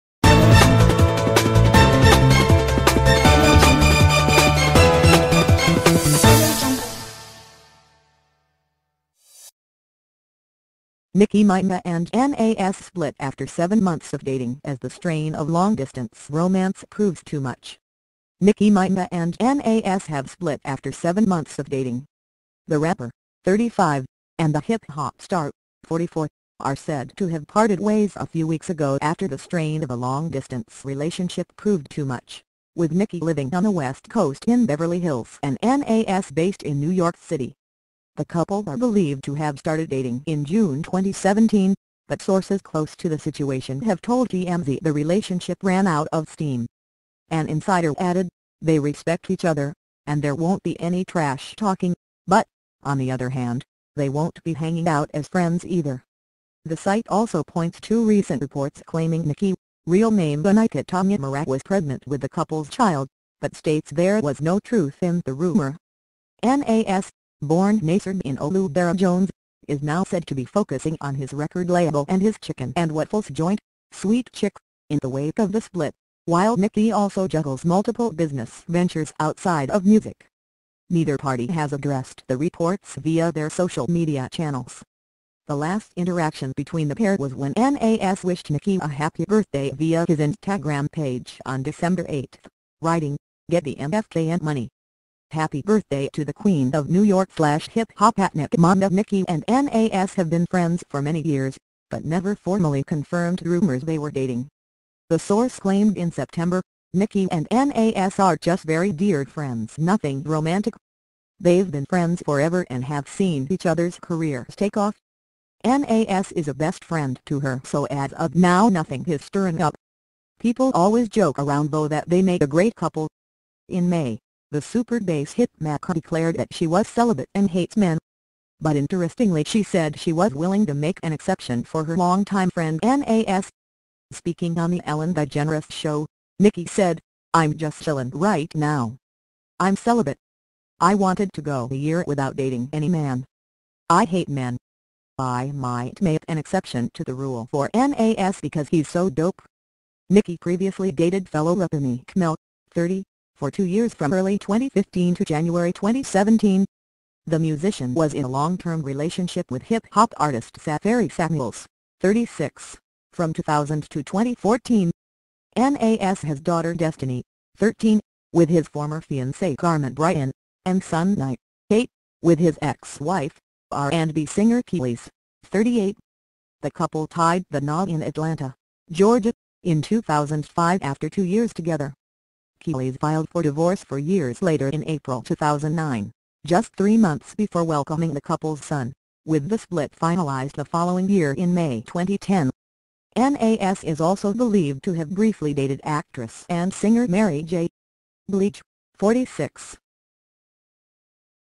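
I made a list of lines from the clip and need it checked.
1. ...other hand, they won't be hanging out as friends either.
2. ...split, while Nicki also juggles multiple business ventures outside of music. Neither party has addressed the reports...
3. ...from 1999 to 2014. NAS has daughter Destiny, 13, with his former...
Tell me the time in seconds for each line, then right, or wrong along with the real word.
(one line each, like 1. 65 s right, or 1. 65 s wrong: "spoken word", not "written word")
1. 53 s right
2. 75 s right
3. 163 s wrong: "2000", not "1999".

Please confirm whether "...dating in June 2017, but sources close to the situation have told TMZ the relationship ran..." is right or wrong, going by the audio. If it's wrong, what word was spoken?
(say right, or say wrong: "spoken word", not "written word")
right.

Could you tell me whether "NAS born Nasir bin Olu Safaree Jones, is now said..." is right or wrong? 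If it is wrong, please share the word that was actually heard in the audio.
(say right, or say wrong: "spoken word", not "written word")
wrong: "Dara", not "Safaree".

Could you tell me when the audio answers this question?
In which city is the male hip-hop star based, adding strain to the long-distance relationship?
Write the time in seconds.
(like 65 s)
36 s.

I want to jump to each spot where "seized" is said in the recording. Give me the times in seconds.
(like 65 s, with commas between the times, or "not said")
not said.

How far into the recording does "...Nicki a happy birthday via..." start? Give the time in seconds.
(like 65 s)
88 s.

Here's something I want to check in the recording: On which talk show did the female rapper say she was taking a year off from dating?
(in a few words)
Ellen DeGeneres show.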